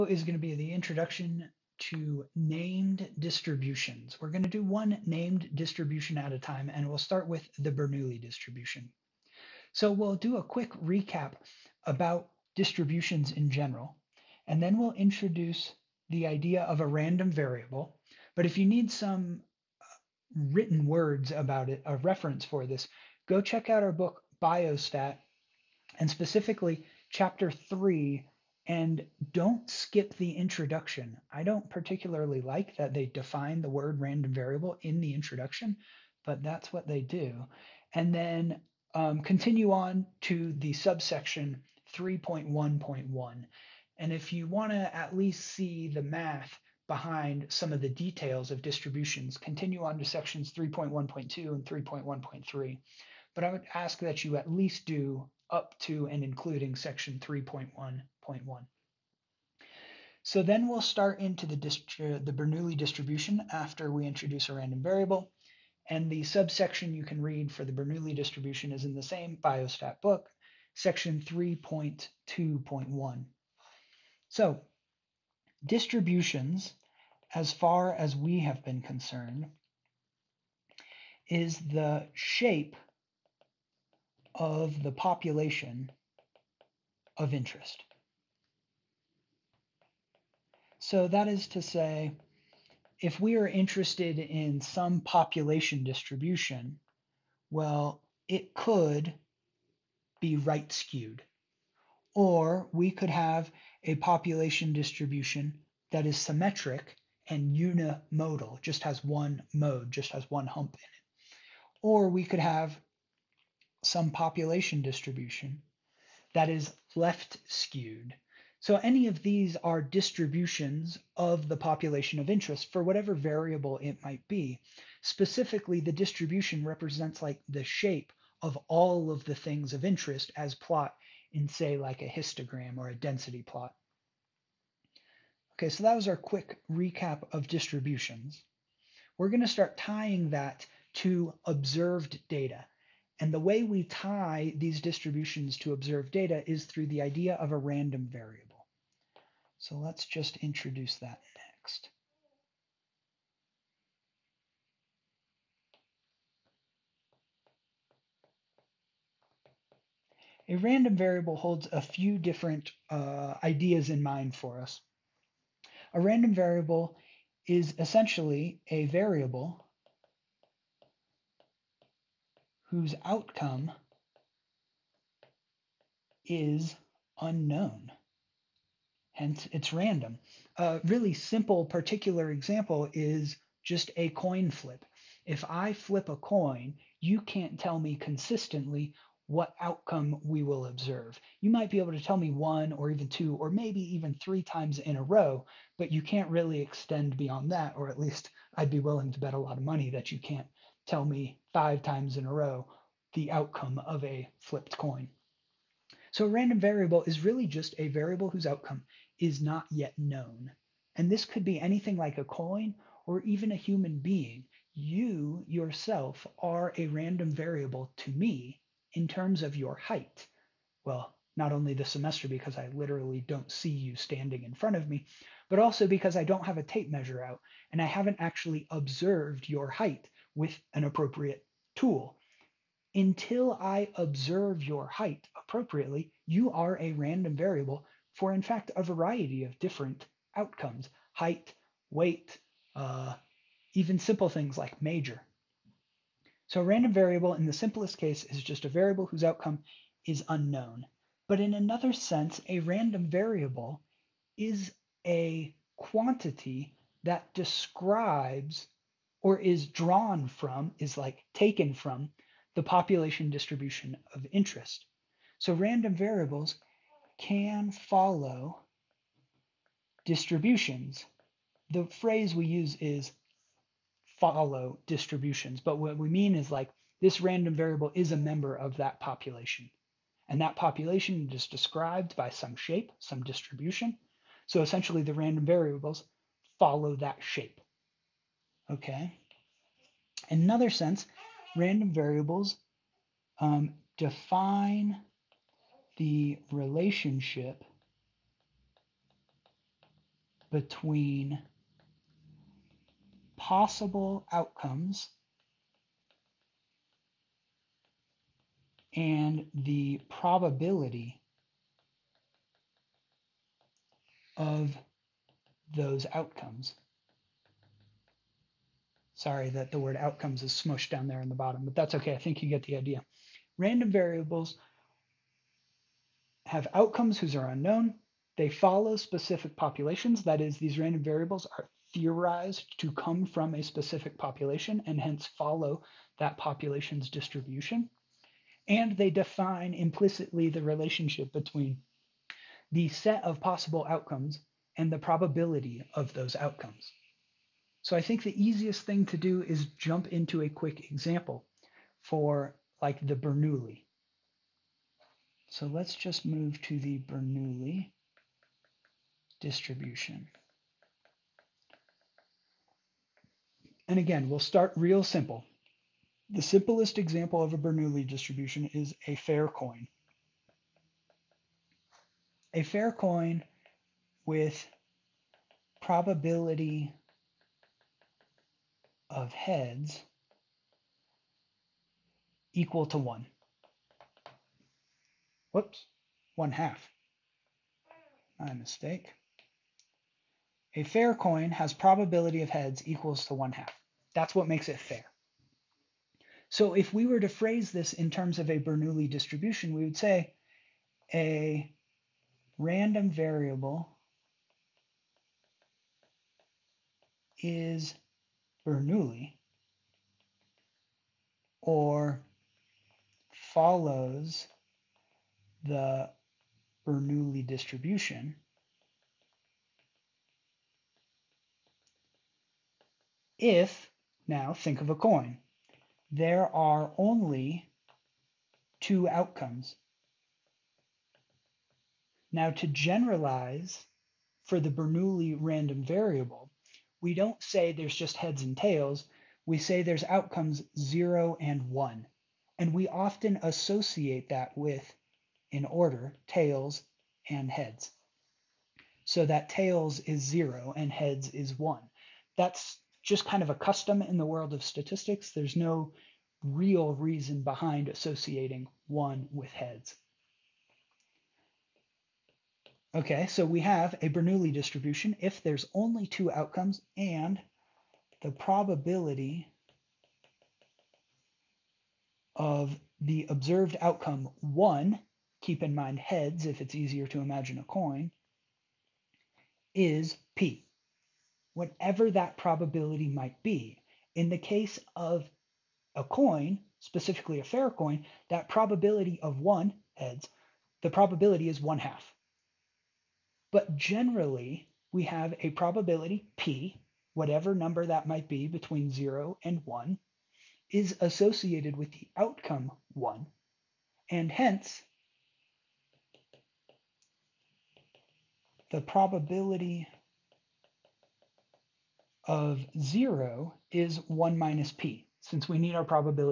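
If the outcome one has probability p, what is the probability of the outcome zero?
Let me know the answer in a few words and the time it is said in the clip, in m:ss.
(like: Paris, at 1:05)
1 minus p, at 8:34.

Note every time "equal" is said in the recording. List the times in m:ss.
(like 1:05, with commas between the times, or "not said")
6:22, 6:32.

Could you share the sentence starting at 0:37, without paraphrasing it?
And then um, continue on to the subsection 3.1.1.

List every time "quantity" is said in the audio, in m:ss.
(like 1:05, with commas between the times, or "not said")
4:15.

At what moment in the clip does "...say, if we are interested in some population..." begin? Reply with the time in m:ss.
1:31.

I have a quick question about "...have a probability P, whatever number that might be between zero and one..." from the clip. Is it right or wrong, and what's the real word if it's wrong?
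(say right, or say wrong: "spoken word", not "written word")
right.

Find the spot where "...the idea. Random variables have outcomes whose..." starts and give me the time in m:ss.
5:22.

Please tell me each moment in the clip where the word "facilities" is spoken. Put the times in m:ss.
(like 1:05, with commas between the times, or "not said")
not said.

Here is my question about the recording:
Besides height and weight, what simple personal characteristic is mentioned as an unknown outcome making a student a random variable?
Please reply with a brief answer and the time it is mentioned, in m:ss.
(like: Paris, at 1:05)
Major, at 4:04.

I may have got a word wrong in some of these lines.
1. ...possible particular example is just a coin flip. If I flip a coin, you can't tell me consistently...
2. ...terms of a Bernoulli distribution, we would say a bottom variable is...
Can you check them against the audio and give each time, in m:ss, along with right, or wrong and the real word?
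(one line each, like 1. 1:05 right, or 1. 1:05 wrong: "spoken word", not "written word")
1. 3:01 wrong: "simple", not "possible"
2. 6:38 wrong: "random", not "bottom".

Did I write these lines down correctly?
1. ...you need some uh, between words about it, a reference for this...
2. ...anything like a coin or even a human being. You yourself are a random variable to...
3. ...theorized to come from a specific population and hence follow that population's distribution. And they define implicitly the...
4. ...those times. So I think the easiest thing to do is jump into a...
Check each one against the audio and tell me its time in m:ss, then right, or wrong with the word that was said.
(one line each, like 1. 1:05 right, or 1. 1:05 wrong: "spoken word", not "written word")
1. 0:18 wrong: "written", not "between"
2. 3:31 right
3. 5:31 right
4. 5:46 wrong: "outcomes", not "times".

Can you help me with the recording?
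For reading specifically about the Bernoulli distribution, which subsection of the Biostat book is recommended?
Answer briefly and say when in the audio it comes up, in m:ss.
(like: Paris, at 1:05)
3.2.1, at 1:10.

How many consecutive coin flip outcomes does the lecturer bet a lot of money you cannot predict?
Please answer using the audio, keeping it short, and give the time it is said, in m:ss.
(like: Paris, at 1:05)
5, at 3:21.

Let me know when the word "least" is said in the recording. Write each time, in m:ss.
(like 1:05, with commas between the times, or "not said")
0:45, 0:54, 3:17.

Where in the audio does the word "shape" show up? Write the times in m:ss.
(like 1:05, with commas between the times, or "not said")
1:22, 2:07, 4:42, 4:47.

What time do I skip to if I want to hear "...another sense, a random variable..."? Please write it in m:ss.
4:11.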